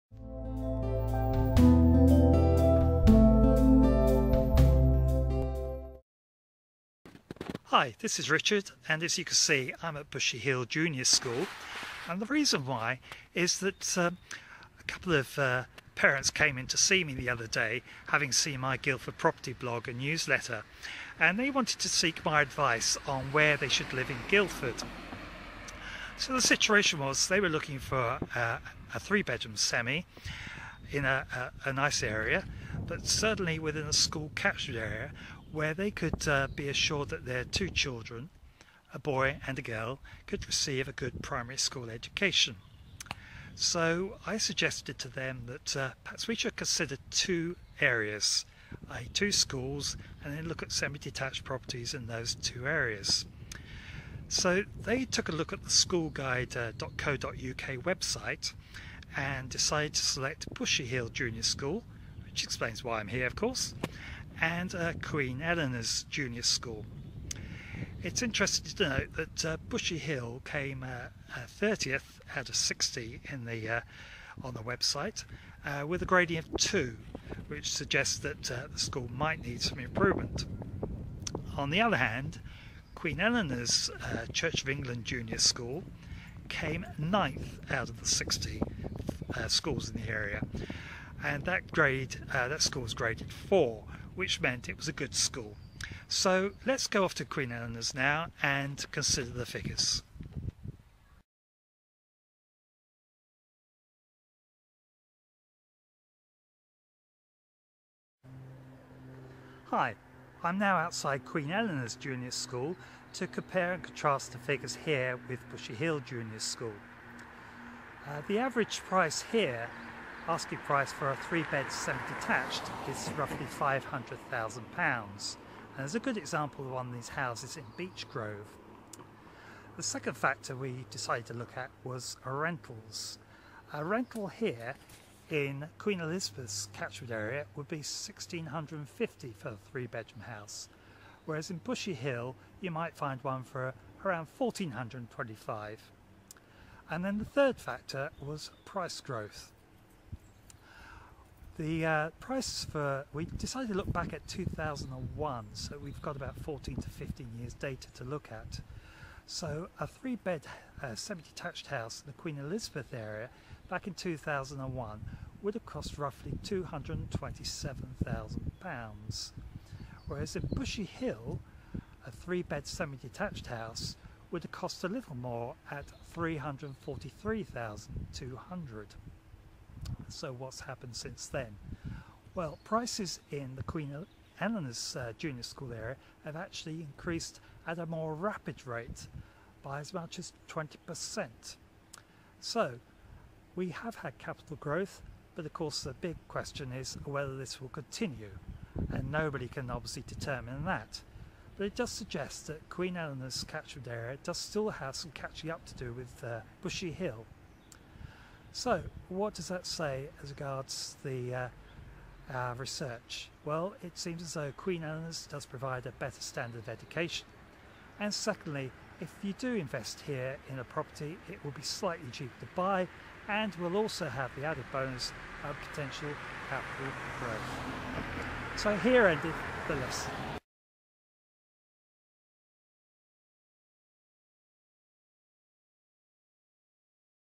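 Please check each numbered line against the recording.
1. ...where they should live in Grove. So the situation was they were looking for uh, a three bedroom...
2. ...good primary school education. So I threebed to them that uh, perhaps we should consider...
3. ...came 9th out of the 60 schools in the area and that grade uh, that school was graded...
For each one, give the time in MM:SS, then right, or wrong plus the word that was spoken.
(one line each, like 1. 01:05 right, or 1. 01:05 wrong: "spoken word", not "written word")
1. 00:23 wrong: "Guildford", not "Grove"
2. 00:40 wrong: "suggested", not "threebed"
3. 01:26 right.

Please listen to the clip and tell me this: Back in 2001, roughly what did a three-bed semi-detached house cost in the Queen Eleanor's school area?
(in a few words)
£227,000.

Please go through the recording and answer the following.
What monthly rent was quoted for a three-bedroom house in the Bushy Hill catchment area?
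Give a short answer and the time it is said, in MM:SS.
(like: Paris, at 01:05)
1425, at 02:24.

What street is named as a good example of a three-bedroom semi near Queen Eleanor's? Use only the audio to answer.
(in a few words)
Beech Grove.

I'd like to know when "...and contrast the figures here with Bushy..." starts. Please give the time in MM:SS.
01:53.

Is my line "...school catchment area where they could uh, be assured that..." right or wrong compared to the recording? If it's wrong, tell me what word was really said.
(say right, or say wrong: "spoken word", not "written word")
right.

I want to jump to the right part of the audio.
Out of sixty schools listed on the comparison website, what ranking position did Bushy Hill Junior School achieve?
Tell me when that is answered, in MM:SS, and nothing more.
01:11.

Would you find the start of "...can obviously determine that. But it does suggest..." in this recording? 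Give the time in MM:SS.
03:19.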